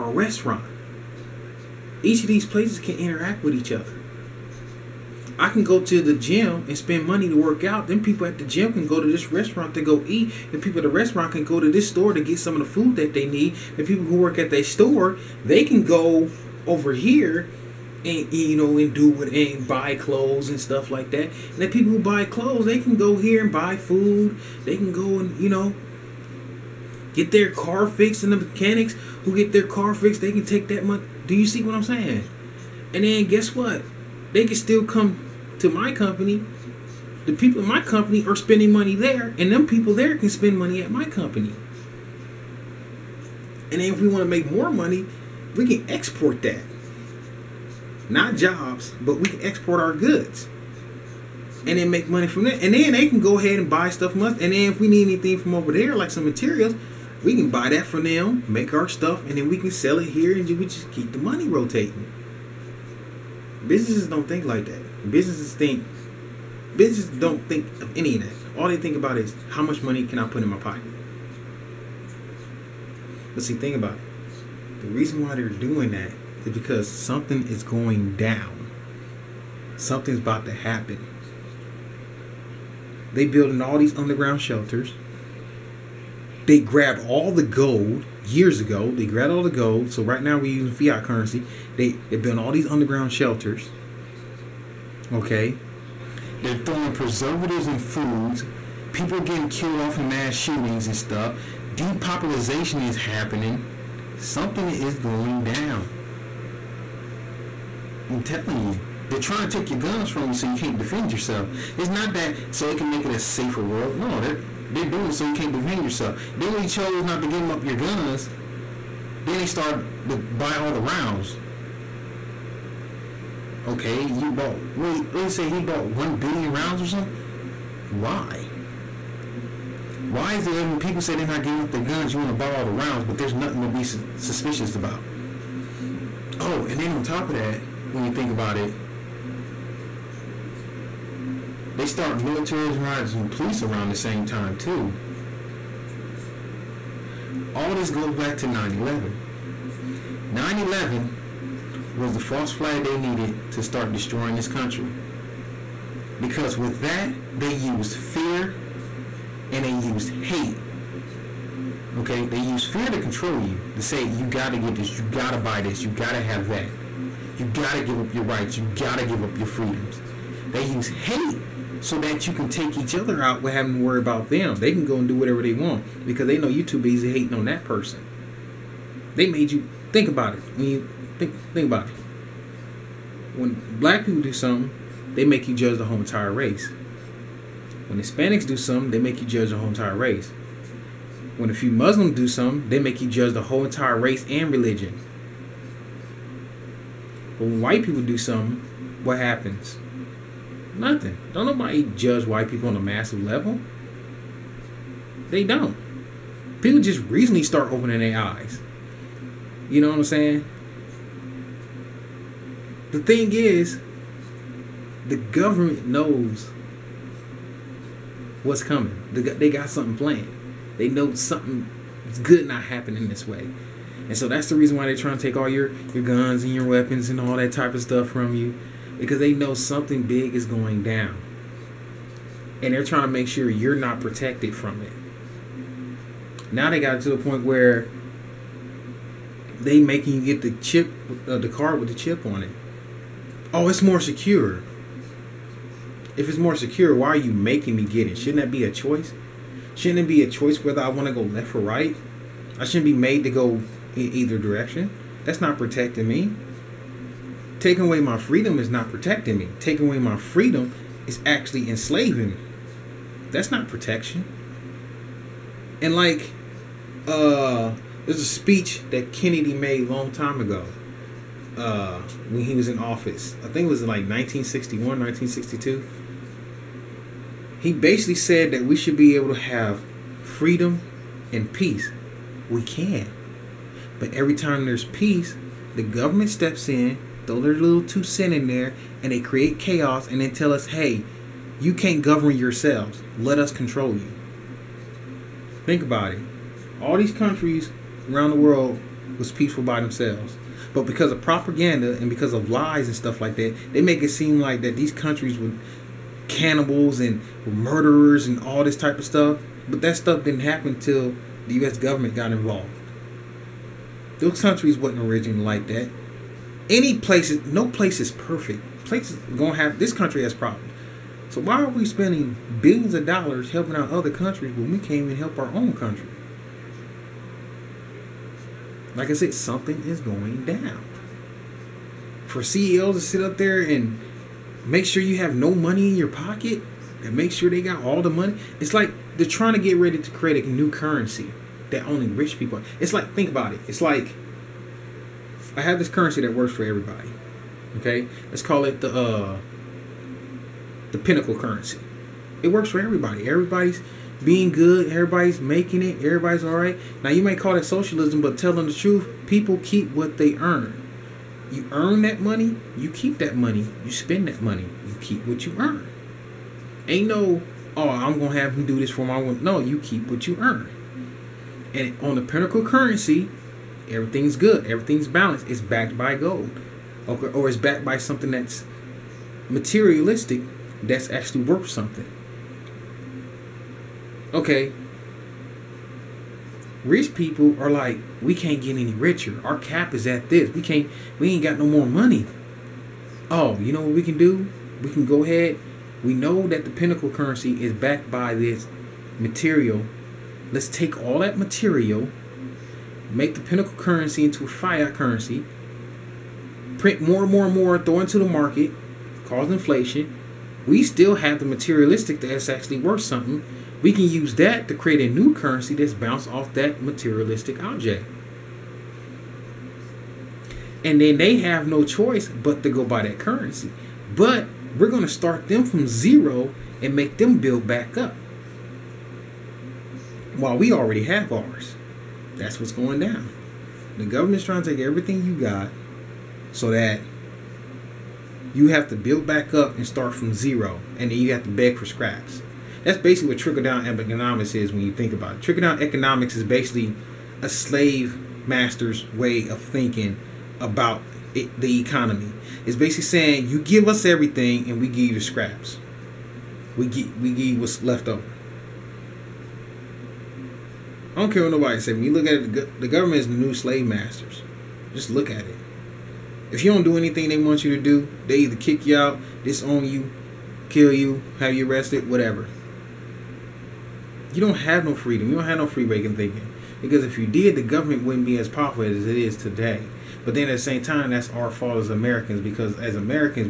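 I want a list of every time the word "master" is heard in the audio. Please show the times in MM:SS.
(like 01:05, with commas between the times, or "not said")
07:28, 07:43.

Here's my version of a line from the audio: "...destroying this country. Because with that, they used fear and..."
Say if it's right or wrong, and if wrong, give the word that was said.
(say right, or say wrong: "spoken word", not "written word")
right.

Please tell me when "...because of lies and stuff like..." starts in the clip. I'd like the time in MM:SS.
05:02.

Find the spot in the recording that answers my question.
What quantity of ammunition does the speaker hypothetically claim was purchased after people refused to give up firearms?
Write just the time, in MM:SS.
02:05.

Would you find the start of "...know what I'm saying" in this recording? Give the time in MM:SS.
03:29.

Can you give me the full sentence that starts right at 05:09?
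But that stuff didn't happen till the U.S.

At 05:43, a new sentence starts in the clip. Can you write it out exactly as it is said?
It's like I have this currency that works for everybody.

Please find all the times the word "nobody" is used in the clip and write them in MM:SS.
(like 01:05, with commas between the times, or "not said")
03:21, 07:41.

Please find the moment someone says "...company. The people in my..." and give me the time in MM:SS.
00:35.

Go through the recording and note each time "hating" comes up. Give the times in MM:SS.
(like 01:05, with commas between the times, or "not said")
02:57.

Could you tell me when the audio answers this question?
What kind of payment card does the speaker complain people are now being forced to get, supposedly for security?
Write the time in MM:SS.
04:01.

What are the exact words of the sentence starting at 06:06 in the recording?
Ain't no, oh, I'm gonna have him do this for my.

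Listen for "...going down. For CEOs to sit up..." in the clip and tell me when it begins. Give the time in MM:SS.
05:30.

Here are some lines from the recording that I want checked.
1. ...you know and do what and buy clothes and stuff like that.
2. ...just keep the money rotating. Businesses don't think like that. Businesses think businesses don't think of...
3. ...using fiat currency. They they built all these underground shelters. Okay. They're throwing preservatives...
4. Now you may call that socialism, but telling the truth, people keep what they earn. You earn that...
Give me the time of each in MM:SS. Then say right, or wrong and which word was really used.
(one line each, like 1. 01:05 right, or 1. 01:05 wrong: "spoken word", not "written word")
1. 00:18 right
2. 01:00 right
3. 01:30 right
4. 05:57 right.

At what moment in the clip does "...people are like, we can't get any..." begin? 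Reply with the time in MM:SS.
06:27.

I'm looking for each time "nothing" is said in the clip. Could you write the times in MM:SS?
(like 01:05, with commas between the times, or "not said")
02:13, 03:20.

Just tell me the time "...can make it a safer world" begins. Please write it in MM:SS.
01:52.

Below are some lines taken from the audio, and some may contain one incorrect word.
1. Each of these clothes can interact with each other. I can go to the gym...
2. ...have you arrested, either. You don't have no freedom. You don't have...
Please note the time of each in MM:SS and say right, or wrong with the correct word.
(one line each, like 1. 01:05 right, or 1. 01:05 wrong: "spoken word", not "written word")
1. 00:02 wrong: "places", not "clothes"
2. 07:51 wrong: "whatever", not "either".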